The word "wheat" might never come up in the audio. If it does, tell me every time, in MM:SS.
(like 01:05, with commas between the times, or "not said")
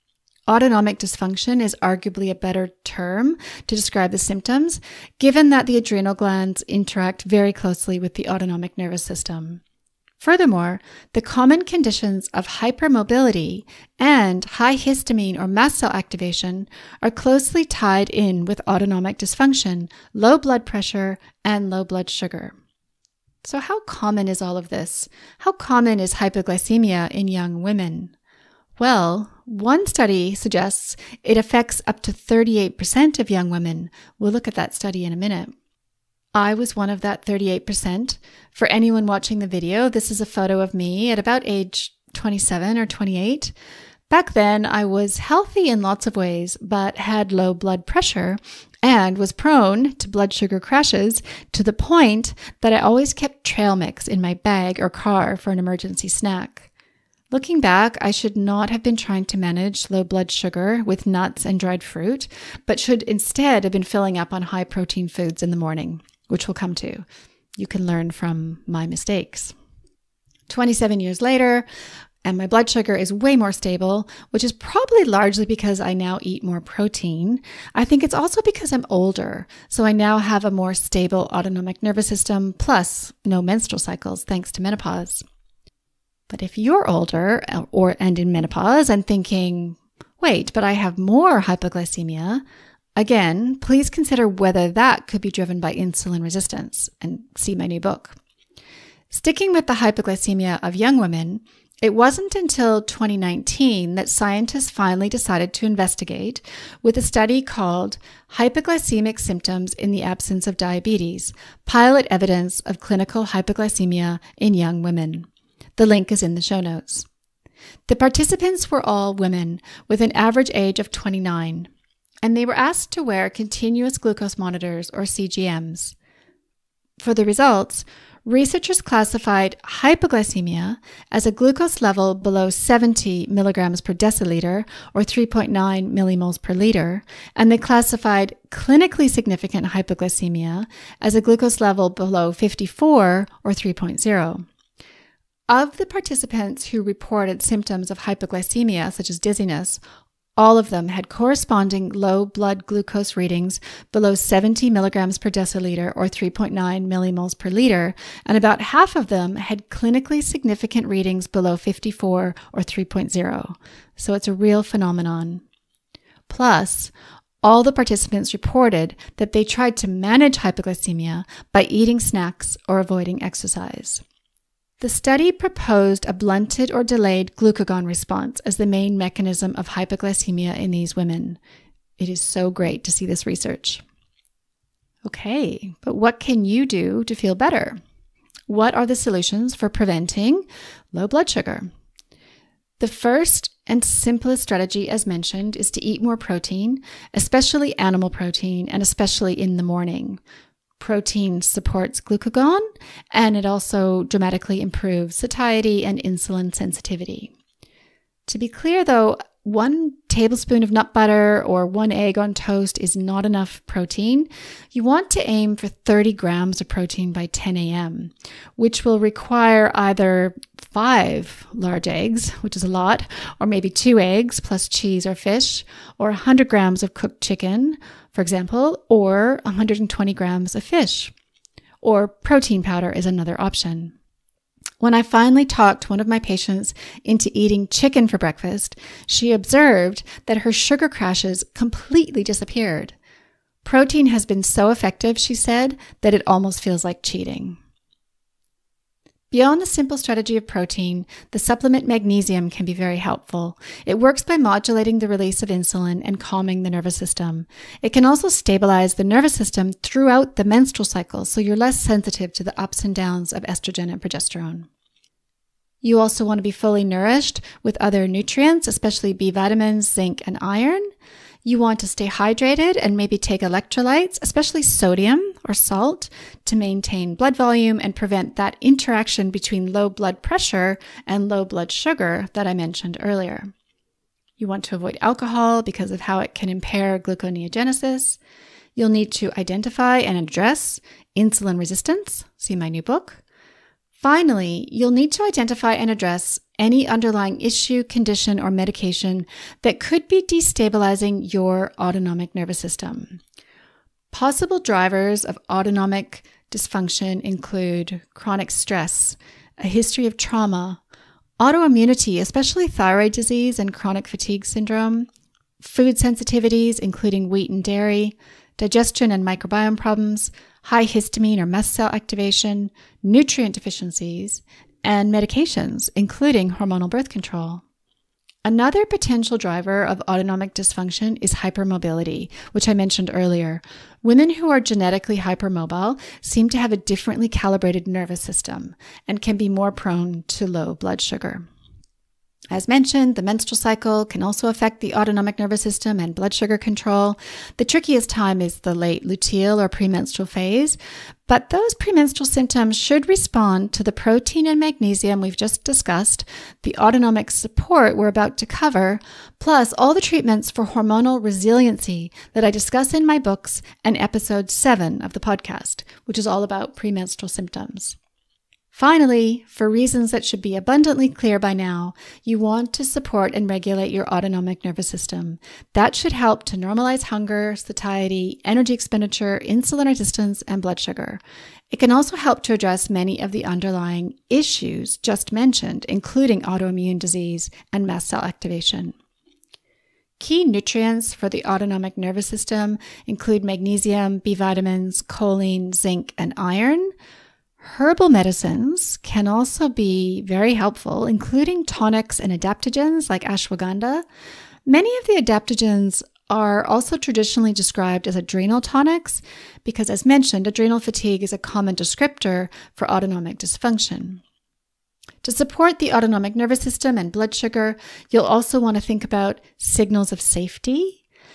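05:17.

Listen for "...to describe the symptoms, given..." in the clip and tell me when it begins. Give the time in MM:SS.
00:03.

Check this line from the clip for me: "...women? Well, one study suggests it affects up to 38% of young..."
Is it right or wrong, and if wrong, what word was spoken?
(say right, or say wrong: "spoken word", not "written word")
right.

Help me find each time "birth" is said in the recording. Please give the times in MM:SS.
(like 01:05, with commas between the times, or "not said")
05:26.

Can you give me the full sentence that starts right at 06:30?
Key nutrients for the autonomic nervous system include magnesium, B vitamins, choline, zinc, and iron.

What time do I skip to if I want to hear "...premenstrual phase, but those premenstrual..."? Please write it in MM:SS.
05:49.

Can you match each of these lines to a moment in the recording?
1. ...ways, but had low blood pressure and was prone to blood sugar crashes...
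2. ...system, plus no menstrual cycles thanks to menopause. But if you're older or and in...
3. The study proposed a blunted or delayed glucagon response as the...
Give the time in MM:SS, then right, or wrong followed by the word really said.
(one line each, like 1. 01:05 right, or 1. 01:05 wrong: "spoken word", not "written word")
1. 00:46 right
2. 01:22 right
3. 02:54 right.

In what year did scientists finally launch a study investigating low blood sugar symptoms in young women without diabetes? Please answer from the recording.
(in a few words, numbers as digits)
2019.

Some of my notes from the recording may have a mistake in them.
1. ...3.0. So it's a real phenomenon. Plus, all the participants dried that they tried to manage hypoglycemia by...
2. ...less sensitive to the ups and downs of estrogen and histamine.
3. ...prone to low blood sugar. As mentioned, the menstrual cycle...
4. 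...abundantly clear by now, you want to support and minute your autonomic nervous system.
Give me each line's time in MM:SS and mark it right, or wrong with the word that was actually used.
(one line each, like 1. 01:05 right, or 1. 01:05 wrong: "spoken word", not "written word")
1. 02:42 wrong: "reported", not "dried"
2. 04:21 wrong: "progesterone", not "histamine"
3. 05:39 right
4. 06:10 wrong: "regulate", not "minute".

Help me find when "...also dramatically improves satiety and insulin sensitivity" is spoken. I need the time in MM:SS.
03:23.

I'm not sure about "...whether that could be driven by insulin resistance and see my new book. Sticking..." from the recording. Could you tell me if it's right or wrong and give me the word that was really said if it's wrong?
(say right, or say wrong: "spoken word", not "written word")
right.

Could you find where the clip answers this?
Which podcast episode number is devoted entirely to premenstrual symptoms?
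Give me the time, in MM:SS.
06:03.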